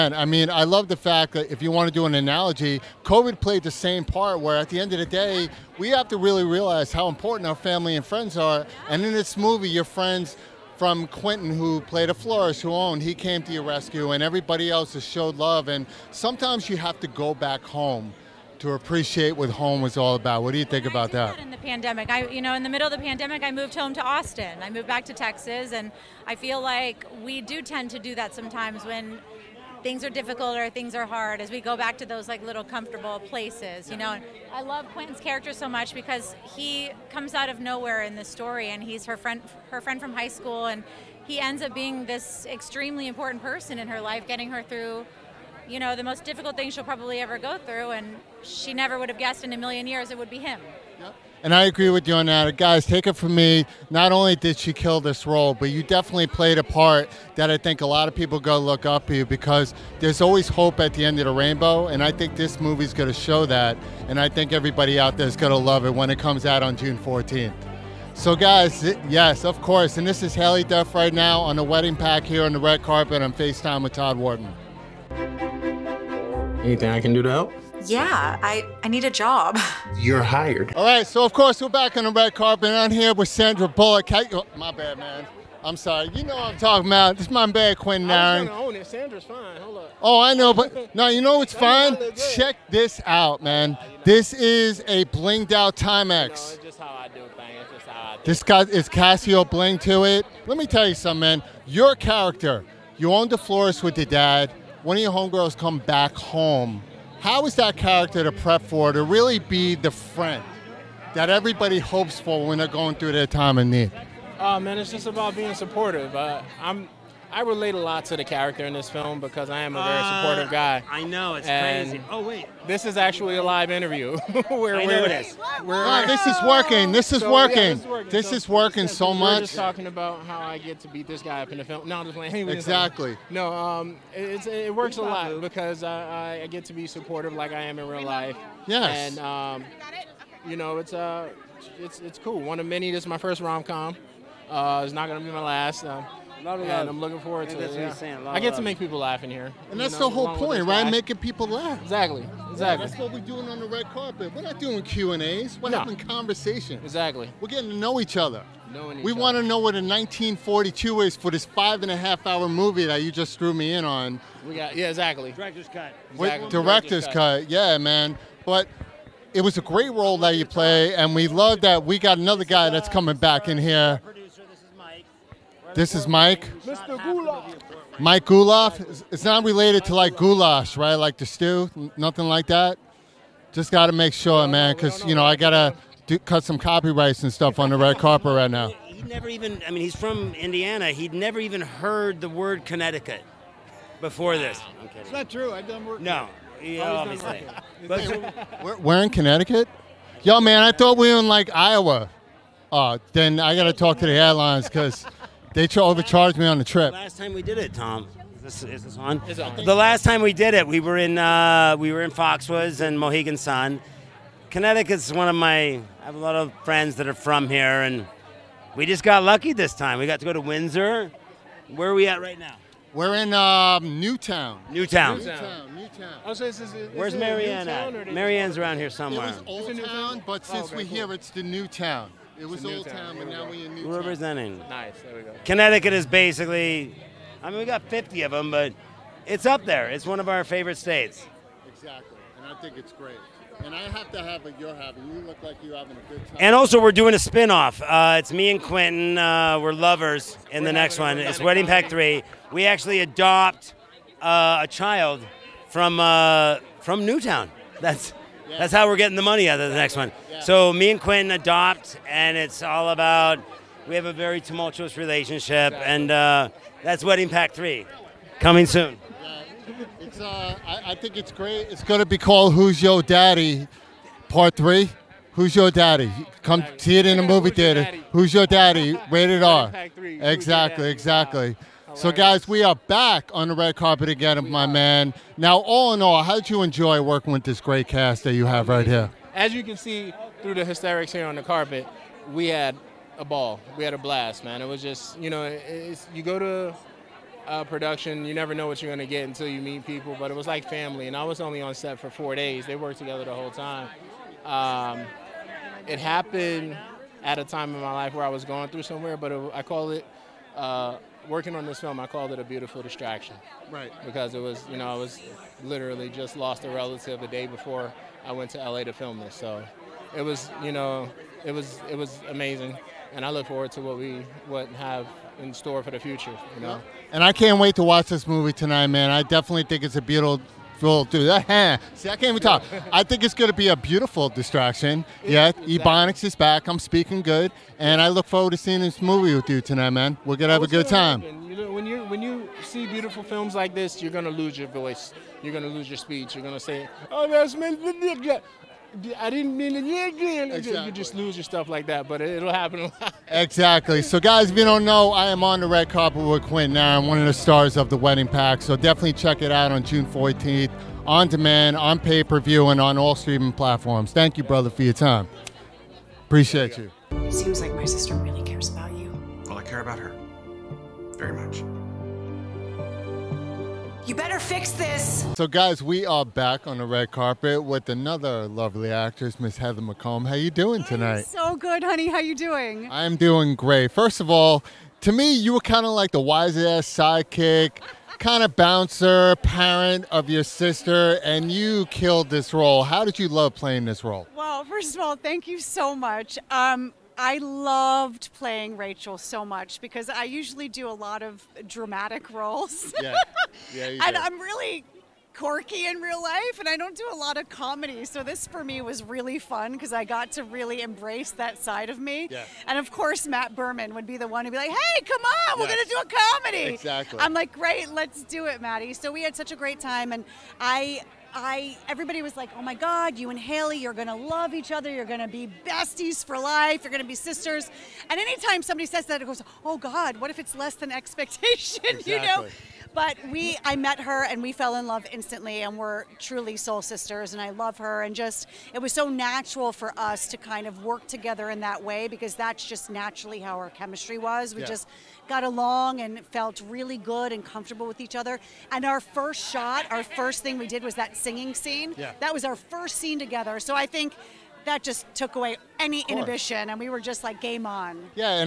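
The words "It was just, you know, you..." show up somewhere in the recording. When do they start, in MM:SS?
04:54.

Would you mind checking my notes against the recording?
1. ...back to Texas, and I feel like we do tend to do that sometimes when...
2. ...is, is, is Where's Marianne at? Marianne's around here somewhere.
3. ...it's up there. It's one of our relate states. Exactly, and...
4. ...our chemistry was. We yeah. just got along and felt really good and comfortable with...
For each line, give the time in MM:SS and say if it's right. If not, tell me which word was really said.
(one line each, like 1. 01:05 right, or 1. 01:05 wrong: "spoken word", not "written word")
1. 00:24 right
2. 03:46 right
3. 03:59 wrong: "favorite", not "relate"
4. 07:23 right.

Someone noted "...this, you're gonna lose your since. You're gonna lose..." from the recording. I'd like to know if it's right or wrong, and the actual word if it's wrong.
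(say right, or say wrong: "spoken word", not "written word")
wrong: "voice", not "since".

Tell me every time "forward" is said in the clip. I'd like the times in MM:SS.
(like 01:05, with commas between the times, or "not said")
02:27, 05:23, 05:38.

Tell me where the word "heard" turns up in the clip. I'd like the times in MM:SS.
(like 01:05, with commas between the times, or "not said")
03:11.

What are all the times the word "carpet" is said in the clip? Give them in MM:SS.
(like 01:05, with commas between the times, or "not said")
01:12, 01:22, 02:33, 03:07, 04:43, 04:51, 05:55, 06:17.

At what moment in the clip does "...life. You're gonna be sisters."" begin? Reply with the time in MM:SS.
07:06.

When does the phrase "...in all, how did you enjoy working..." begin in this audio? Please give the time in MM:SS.
04:45.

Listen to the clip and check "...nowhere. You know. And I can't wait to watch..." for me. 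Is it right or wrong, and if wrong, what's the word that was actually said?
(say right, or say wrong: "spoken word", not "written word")
wrong: "future", not "nowhere".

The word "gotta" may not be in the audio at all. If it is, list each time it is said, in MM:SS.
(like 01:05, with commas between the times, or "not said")
03:05, 03:23.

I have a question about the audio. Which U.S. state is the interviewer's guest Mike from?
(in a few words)
Indiana.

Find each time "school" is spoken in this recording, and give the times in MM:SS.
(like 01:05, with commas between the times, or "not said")
00:40.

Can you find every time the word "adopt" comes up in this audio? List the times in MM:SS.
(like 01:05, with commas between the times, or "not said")
04:13, 04:21.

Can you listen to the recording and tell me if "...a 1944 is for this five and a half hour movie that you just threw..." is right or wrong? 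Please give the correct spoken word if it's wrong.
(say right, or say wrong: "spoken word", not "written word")
wrong: "1942", not "1944".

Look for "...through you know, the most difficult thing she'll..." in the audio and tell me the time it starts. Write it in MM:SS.
00:44.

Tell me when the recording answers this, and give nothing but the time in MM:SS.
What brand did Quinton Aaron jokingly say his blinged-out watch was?
01:35.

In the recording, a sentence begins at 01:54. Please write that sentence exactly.
Uh, man, it's just about being supportive.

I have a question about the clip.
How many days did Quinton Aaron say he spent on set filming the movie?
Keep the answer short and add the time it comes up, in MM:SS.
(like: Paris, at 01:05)
4, at 05:02.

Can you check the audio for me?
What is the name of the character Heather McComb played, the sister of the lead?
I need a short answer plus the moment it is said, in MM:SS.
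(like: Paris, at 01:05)
Rachel, at 06:38.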